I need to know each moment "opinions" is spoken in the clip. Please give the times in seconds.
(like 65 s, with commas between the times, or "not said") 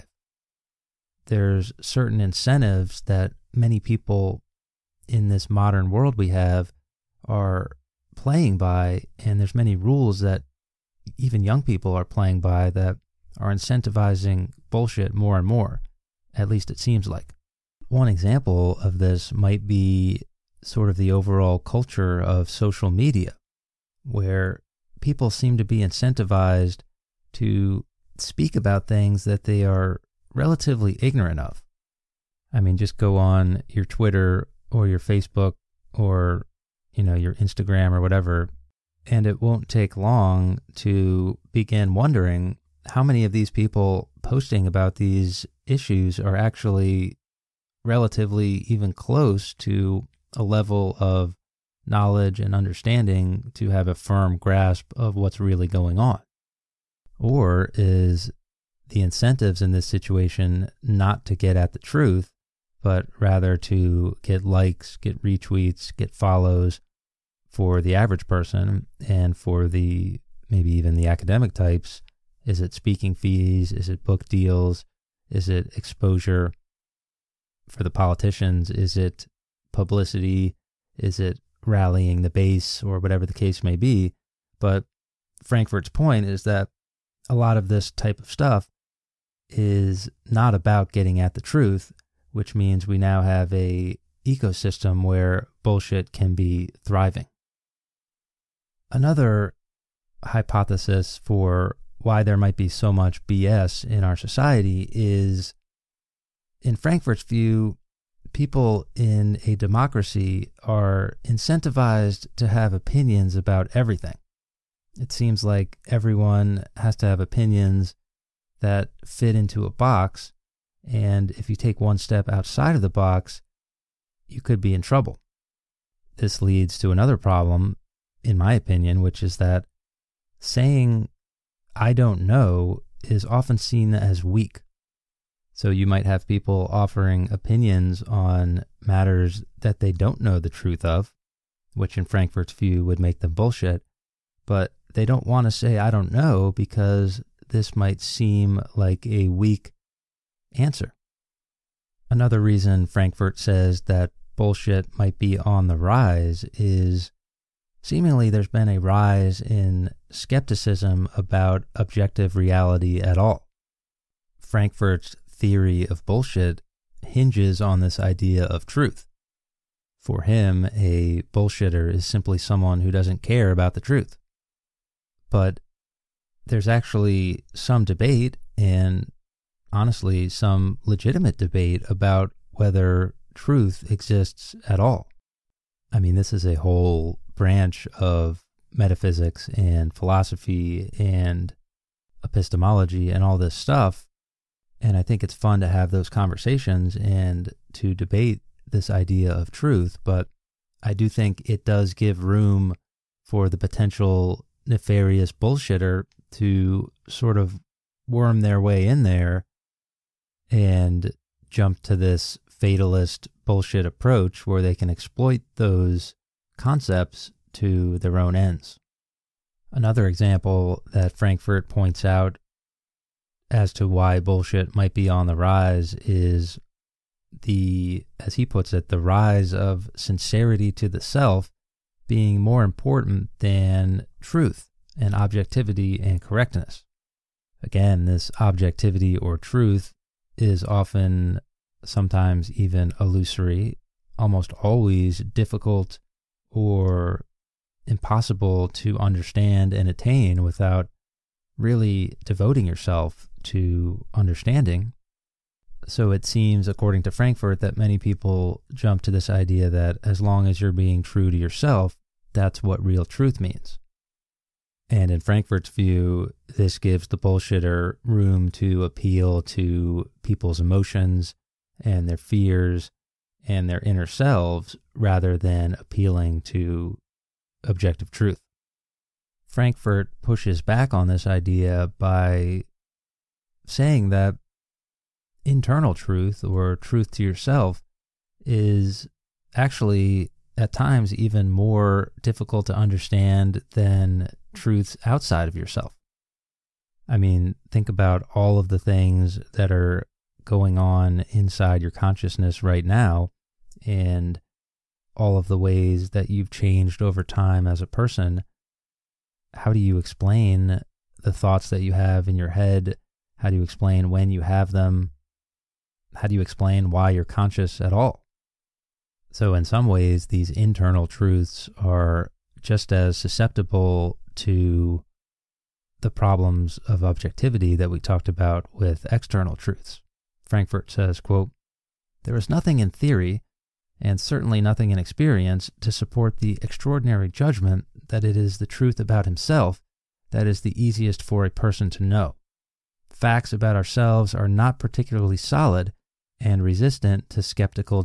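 112 s, 117 s, 128 s, 137 s.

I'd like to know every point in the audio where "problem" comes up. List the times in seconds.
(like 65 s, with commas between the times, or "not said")
127 s, 326 s.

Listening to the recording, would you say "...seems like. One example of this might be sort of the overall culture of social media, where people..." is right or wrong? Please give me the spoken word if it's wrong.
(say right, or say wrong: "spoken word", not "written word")
right.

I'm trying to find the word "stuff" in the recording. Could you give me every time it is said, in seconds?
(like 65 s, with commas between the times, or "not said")
88 s, 193 s.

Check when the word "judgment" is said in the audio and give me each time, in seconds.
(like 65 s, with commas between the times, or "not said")
337 s.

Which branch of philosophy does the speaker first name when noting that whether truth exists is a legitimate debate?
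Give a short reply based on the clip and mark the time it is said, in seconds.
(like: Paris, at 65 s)
Metaphysics, at 188 s.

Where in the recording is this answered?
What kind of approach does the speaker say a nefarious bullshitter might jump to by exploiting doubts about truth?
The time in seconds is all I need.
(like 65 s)
212 s.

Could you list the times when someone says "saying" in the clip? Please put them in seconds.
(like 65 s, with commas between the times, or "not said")
130 s, 283 s.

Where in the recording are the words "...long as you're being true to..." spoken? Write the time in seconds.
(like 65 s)
260 s.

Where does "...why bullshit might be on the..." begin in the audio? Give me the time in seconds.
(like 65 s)
223 s.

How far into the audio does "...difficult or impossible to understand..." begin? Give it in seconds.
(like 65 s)
245 s.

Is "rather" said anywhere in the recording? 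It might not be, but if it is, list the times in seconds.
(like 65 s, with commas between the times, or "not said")
63 s, 274 s.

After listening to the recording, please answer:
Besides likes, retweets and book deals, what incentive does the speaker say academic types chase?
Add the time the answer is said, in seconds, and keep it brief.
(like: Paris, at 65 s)
Speaking fees, at 72 s.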